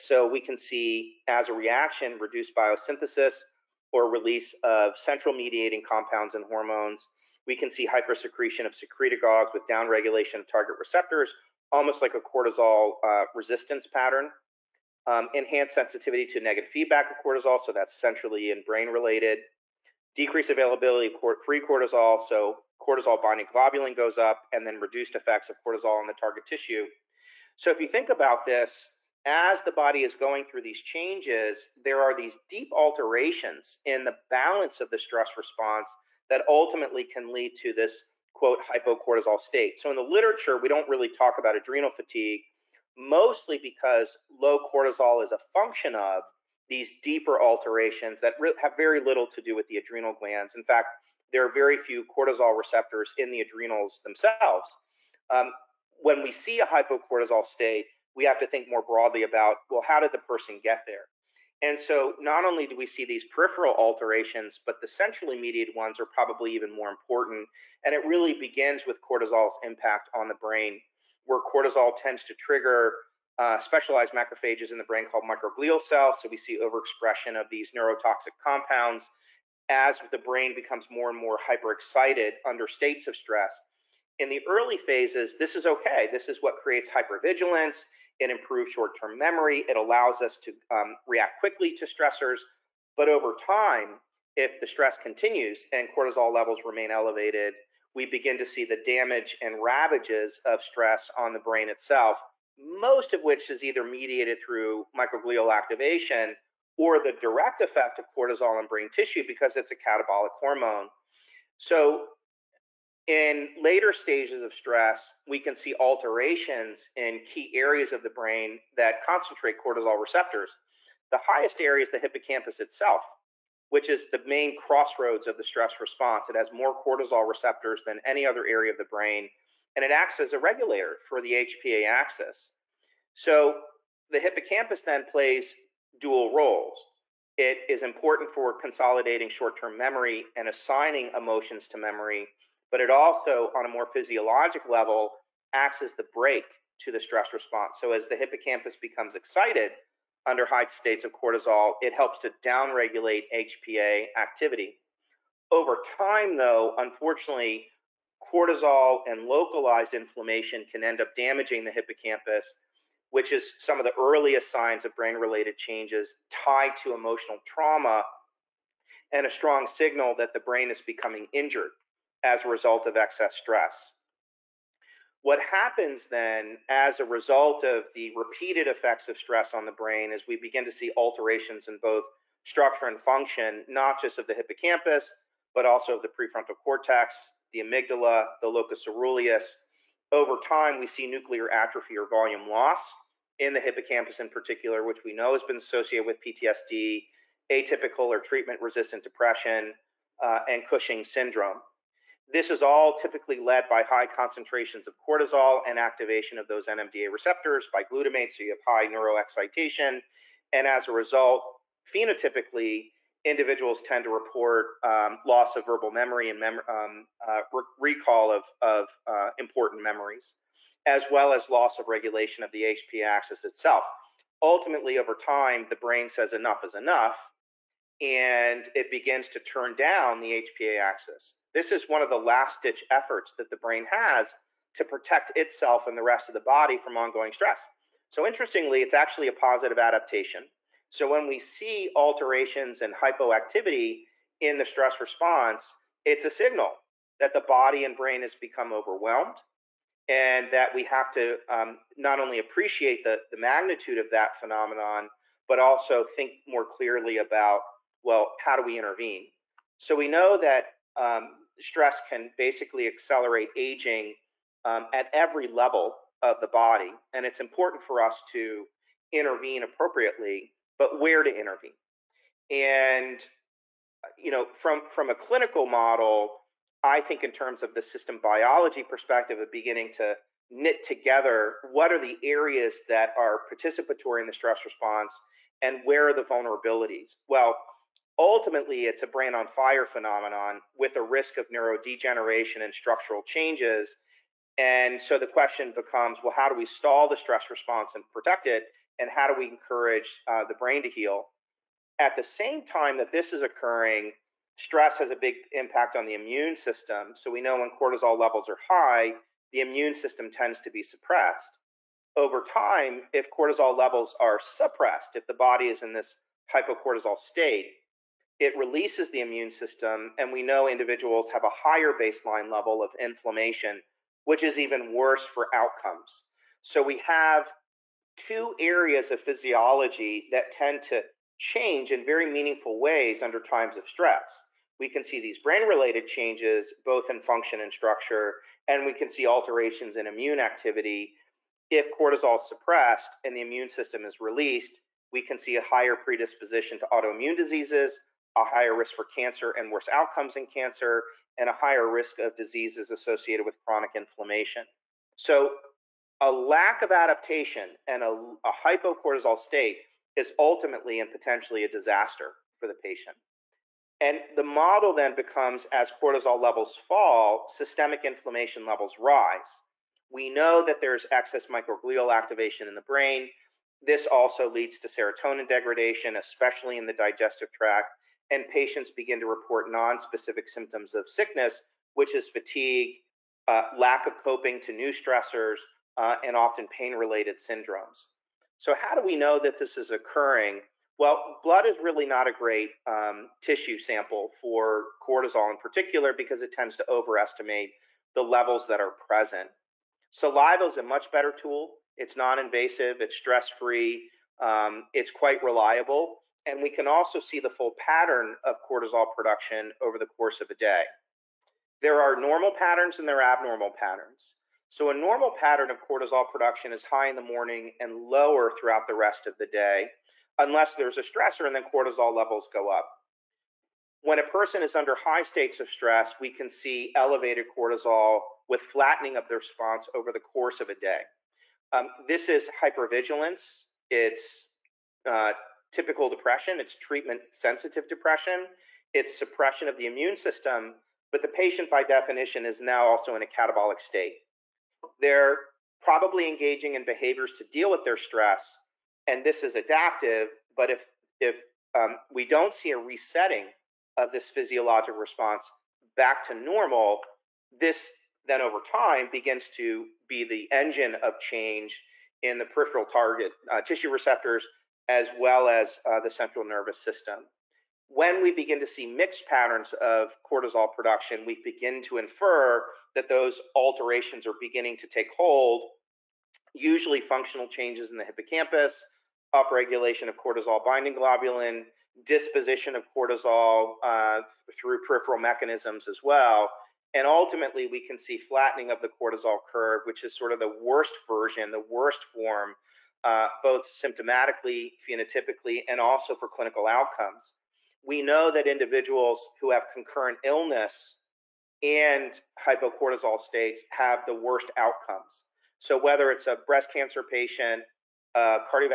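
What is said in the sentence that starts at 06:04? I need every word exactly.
And the model then becomes as cortisol levels fall, systemic inflammation levels rise.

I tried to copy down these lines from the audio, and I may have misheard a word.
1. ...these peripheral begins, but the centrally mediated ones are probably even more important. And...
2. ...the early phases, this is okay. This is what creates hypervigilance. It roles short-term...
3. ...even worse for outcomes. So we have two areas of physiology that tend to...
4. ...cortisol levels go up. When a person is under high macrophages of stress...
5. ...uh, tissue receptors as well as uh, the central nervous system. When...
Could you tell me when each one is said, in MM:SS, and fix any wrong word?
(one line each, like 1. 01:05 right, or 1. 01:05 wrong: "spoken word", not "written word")
1. 01:03 wrong: "alterations", not "begins"
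2. 01:24 wrong: "improves", not "roles"
3. 05:24 right
4. 07:01 wrong: "states", not "macrophages"
5. 07:43 right.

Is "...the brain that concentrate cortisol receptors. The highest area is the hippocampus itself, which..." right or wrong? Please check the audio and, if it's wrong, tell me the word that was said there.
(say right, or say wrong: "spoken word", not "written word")
right.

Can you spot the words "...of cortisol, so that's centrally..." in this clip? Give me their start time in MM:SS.
00:17.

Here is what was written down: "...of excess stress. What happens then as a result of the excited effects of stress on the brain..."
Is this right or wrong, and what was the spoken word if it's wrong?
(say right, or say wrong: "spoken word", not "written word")
wrong: "repeated", not "excited".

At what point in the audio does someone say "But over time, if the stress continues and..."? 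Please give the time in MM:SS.
01:32.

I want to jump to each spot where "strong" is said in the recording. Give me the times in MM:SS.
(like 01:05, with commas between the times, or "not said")
02:49.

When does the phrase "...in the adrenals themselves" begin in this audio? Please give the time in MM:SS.
00:53.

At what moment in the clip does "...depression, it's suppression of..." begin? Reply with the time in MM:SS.
07:17.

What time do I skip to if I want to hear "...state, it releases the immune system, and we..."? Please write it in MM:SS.
05:17.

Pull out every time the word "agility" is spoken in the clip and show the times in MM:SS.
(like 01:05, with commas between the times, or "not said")
not said.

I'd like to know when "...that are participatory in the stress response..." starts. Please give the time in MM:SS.
04:42.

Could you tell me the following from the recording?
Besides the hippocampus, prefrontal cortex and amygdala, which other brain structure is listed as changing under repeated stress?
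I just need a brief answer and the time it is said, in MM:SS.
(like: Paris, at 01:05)
Locus ceruleus, at 03:08.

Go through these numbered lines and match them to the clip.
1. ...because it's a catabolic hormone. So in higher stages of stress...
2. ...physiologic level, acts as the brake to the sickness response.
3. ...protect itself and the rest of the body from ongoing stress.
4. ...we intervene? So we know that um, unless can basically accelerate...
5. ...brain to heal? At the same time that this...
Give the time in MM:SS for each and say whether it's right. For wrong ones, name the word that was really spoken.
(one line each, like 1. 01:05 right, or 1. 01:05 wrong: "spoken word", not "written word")
1. 01:49 wrong: "later", not "higher"
2. 02:23 wrong: "stress", not "sickness"
3. 03:54 right
4. 04:18 wrong: "stress", not "unless"
5. 05:00 right.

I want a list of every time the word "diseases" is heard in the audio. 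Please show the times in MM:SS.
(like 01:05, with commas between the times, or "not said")
05:47, 05:52.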